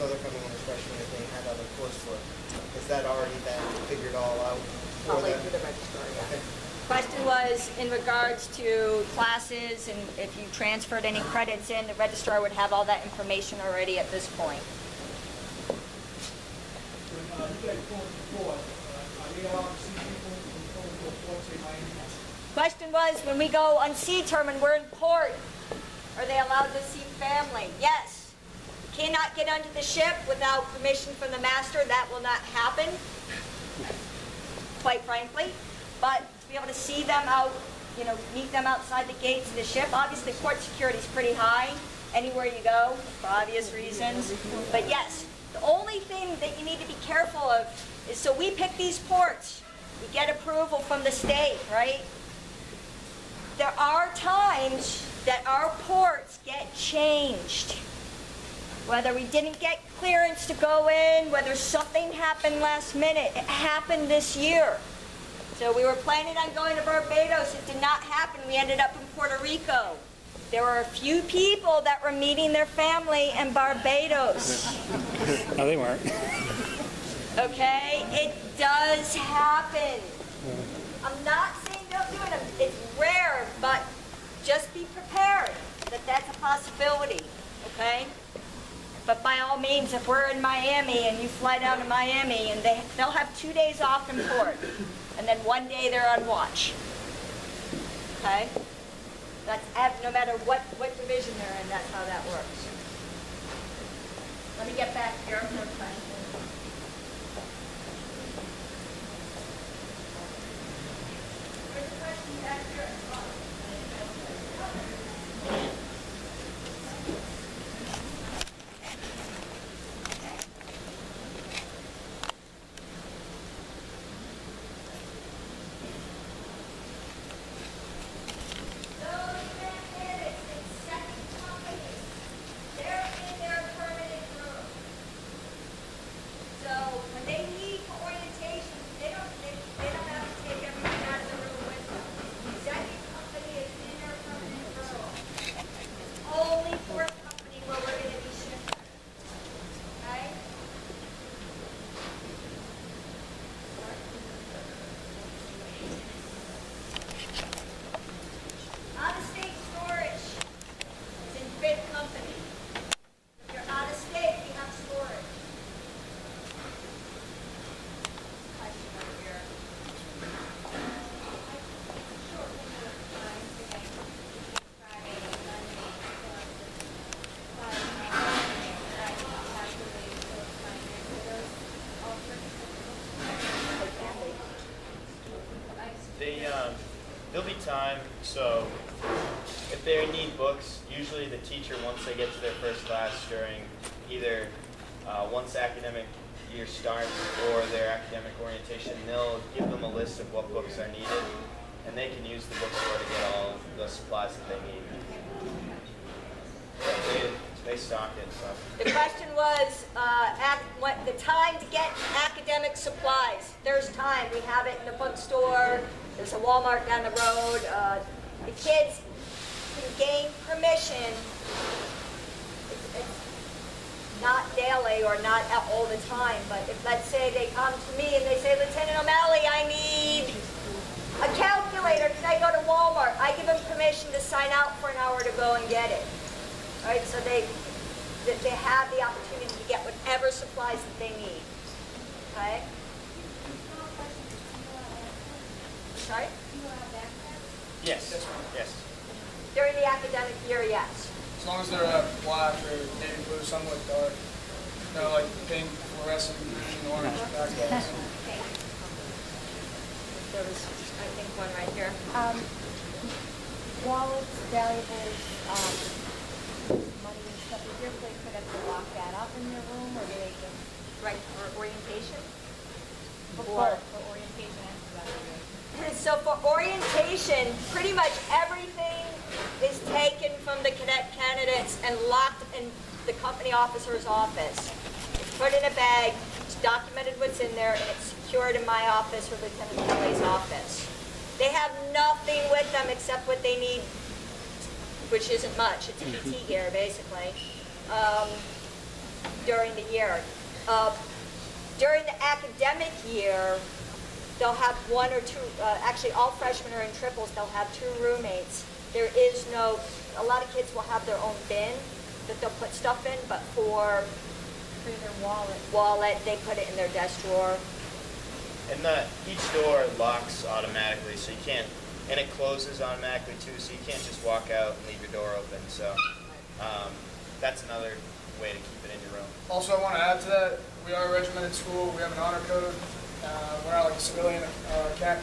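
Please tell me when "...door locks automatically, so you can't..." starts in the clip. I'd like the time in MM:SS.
05:19.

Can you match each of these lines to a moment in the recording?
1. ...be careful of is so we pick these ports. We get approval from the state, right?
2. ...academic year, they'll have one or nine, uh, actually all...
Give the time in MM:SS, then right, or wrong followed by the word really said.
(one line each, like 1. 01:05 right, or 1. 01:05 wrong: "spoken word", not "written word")
1. 00:46 right
2. 05:02 wrong: "two", not "nine".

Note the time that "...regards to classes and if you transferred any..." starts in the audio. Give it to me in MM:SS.
00:07.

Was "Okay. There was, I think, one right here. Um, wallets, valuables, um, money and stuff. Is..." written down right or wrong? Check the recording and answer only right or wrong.
right.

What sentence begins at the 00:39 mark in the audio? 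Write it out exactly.
Obviously, port security is pretty high anywhere you go, for obvious reasons.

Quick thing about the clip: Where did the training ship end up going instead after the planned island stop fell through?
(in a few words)
Puerto Rico.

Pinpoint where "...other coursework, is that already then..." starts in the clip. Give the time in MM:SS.
00:01.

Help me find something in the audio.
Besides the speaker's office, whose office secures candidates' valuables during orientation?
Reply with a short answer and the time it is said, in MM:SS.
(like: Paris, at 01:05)
Lieutenant Kelly, at 04:49.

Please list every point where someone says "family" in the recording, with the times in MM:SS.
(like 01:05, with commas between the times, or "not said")
00:27, 01:12.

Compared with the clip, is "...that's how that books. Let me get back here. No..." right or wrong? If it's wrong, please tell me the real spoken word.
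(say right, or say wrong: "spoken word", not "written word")
wrong: "works", not "books".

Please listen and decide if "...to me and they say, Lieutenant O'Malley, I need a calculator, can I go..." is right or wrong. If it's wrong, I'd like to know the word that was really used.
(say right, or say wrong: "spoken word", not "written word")
right.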